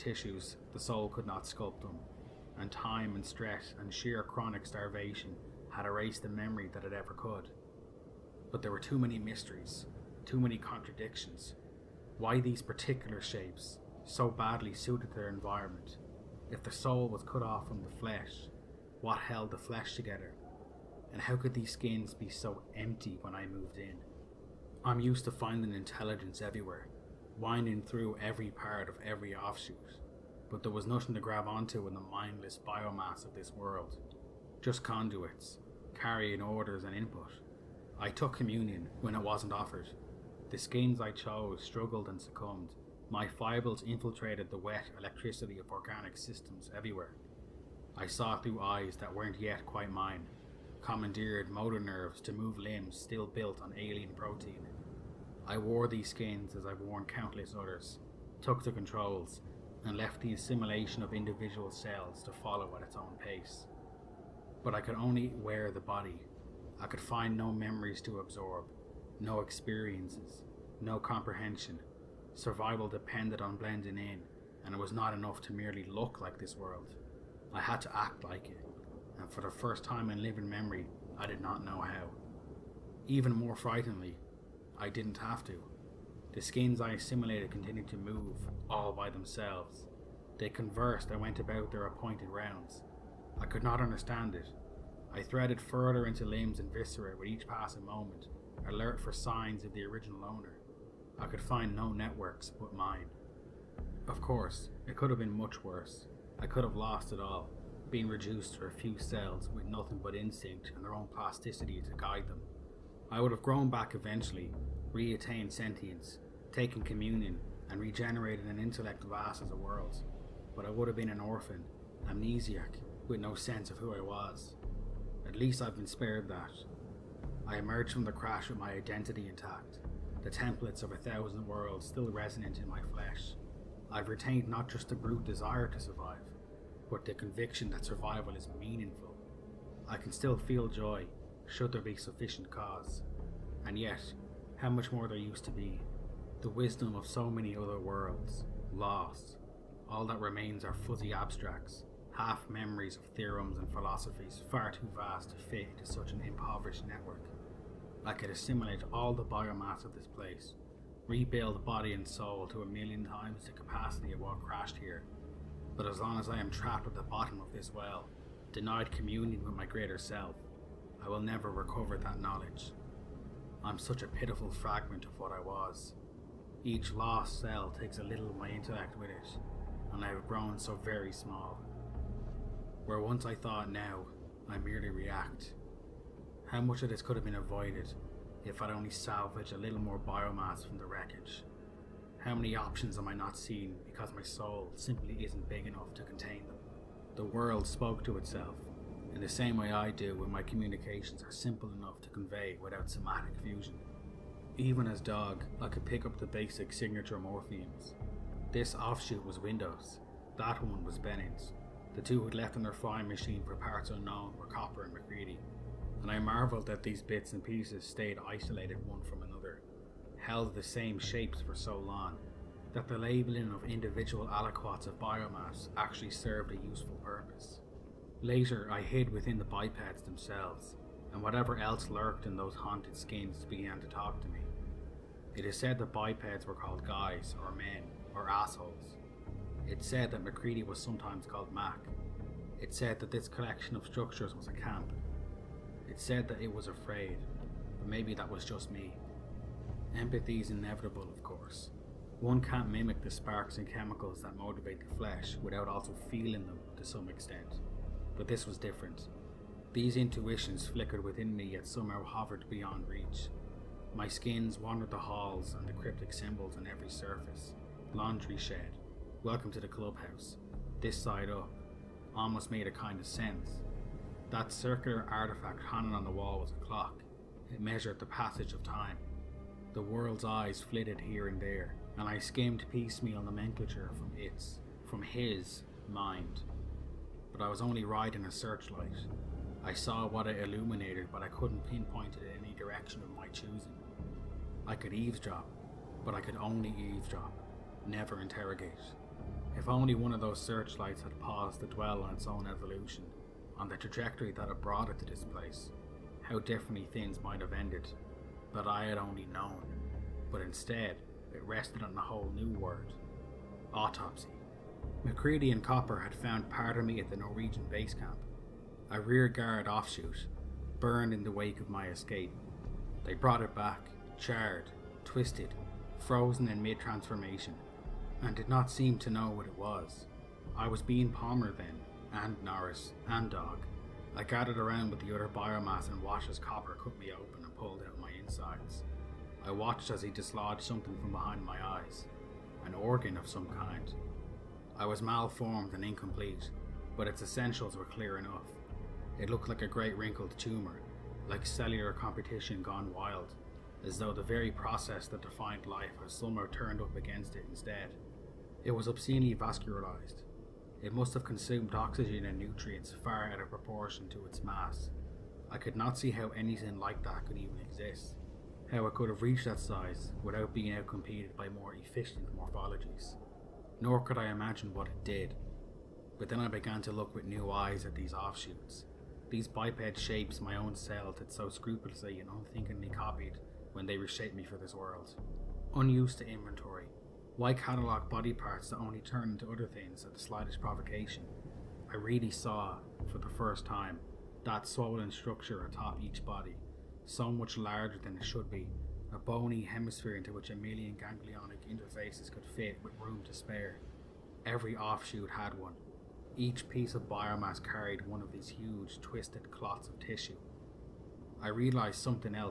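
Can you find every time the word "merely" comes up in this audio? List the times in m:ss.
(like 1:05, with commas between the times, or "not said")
1:15, 3:04.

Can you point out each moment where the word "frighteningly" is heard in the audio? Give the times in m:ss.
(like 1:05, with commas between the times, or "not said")
1:23.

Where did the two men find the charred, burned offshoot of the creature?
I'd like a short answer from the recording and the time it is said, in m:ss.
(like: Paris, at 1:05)
The Norwegian base camp, at 5:17.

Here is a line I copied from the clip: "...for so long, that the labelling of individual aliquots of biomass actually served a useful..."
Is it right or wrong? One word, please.
right.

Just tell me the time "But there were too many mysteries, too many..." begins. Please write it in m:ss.
0:08.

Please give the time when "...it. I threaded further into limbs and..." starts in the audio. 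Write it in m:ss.
1:34.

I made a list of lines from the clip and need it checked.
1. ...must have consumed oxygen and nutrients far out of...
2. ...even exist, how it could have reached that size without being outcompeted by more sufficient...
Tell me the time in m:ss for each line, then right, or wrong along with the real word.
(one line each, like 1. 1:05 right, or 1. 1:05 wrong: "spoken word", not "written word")
1. 6:00 right
2. 6:07 wrong: "efficient", not "sufficient".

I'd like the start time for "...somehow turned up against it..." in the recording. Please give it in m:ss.
5:56.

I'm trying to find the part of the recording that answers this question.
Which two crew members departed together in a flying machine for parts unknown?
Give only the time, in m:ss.
3:34.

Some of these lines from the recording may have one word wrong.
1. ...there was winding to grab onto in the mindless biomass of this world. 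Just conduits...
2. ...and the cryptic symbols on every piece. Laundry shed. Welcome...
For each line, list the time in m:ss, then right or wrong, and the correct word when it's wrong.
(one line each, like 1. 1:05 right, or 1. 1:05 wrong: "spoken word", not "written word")
1. 0:30 wrong: "nothing", not "winding"
2. 4:25 wrong: "surface", not "piece".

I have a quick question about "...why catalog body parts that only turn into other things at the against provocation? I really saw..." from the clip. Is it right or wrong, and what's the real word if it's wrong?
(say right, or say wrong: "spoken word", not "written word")
wrong: "slightest", not "against".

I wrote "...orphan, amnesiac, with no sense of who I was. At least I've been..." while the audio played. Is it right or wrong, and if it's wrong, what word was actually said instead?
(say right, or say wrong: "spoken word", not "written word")
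right.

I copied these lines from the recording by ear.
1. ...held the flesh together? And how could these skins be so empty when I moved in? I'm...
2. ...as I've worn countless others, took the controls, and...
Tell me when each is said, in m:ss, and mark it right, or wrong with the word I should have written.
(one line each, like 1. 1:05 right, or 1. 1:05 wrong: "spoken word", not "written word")
1. 0:19 right
2. 0:56 right.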